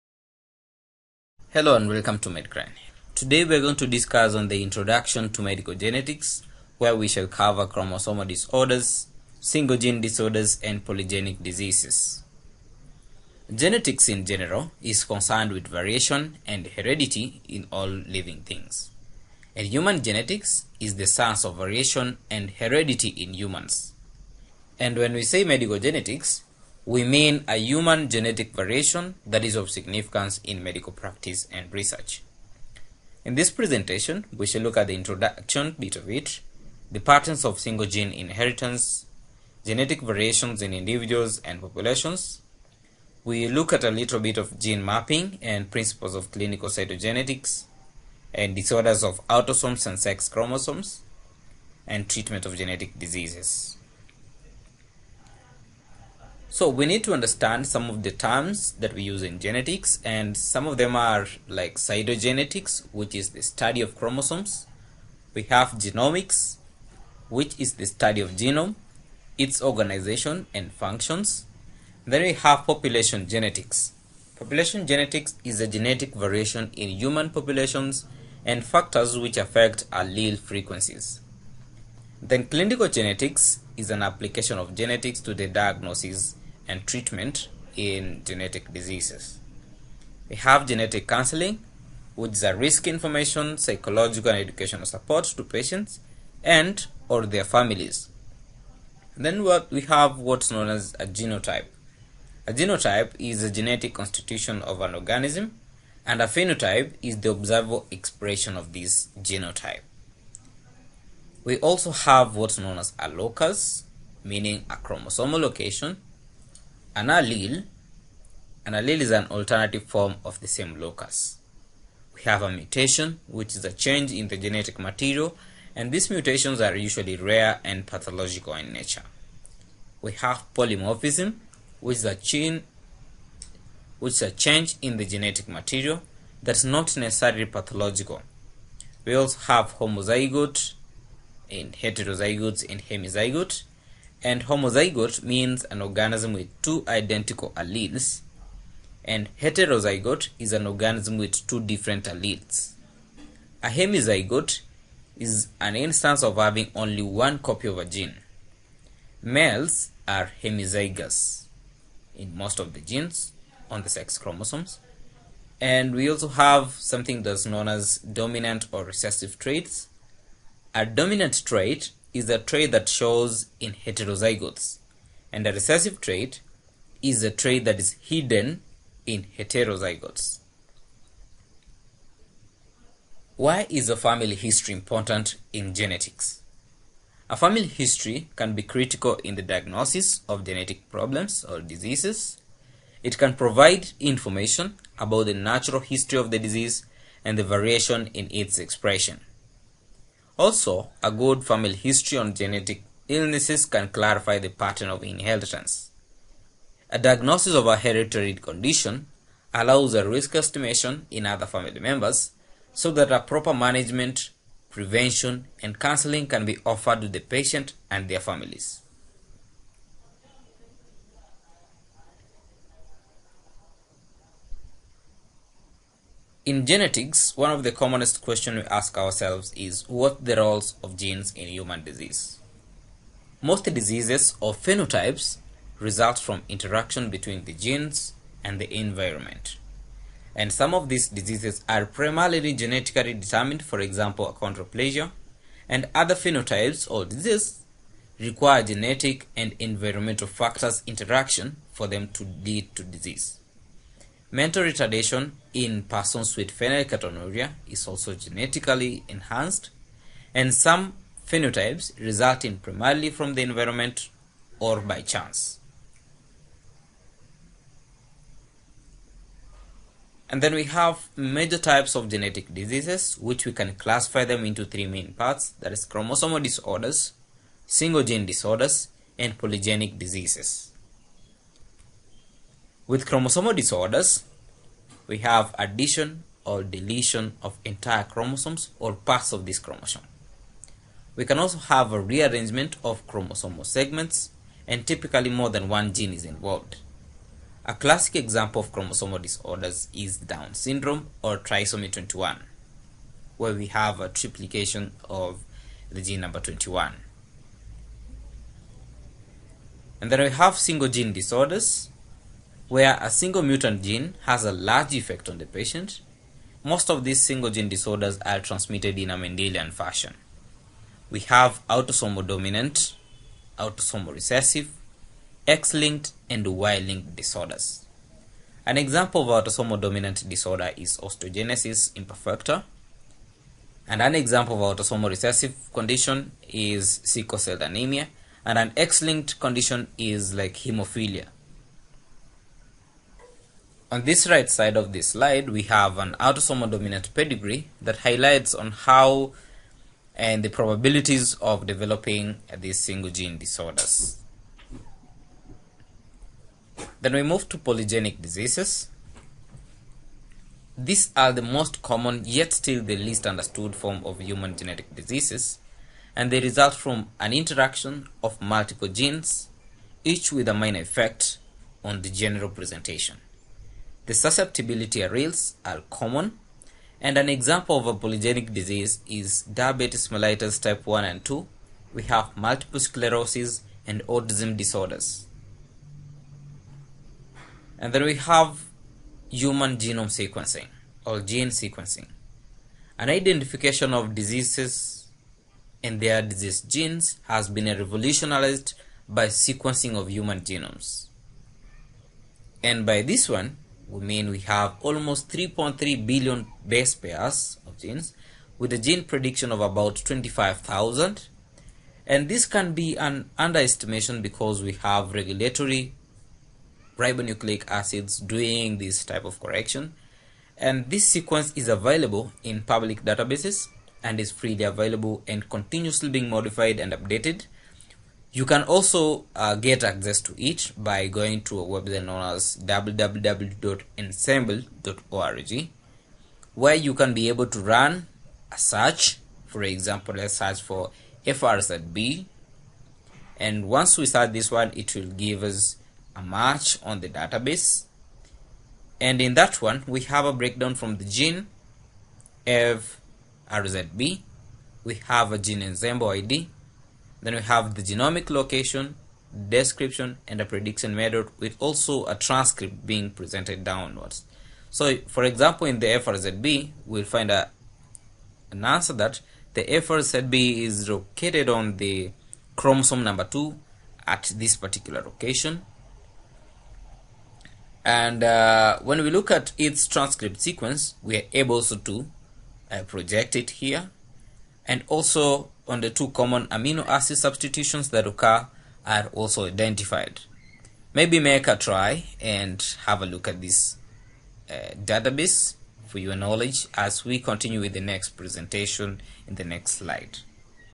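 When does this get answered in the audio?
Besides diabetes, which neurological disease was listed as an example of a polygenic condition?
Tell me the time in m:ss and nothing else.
6:22.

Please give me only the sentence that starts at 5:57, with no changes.
Then we move to polygenic diseases.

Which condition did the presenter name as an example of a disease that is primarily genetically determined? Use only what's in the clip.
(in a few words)
Achondroplasia.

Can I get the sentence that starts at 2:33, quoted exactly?
A hemizygote is an instance of having only one copy of a gene.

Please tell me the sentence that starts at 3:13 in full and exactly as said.
It can provide information about the natural history of the disease and the variation in its expression.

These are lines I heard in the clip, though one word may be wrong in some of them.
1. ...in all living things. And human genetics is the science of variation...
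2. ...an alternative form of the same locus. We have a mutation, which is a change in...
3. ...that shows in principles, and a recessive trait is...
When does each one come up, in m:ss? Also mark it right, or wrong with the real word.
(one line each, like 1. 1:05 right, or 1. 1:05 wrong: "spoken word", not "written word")
1. 0:17 right
2. 1:59 right
3. 2:52 wrong: "heterozygotes", not "principles".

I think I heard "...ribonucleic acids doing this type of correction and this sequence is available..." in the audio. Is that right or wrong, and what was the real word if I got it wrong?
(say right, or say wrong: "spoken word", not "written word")
right.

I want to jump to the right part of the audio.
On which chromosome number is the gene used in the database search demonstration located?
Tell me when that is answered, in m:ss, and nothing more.
7:52.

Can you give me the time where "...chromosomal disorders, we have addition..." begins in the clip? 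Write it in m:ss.
4:43.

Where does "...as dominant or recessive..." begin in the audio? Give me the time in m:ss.
2:47.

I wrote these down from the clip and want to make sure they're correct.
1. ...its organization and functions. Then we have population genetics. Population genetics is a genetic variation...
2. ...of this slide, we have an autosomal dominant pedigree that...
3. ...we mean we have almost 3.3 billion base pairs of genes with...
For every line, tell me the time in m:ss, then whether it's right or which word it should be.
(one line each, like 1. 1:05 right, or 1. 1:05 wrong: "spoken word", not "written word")
1. 1:09 right
2. 5:44 right
3. 6:43 right.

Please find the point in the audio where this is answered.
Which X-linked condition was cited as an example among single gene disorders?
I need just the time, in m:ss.
5:40.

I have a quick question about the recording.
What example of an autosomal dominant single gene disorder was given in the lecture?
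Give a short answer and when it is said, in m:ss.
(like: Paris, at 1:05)
Osteogenesis imperfecta, at 5:30.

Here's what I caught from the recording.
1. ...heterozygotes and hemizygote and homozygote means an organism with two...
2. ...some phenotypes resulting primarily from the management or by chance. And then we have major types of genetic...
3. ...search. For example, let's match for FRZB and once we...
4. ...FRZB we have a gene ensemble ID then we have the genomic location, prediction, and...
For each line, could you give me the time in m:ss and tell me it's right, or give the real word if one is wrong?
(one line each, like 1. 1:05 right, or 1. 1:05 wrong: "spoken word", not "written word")
1. 2:21 right
2. 4:20 wrong: "environment", not "management"
3. 7:18 wrong: "search", not "match"
4. 7:32 wrong: "description", not "prediction".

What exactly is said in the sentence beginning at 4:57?
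A classic example of chromosomal disorders is Down syndrome or trisomy 21, where we have a triplication of the gene number 21.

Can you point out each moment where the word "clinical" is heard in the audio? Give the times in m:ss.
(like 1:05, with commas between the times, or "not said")
0:46, 1:22.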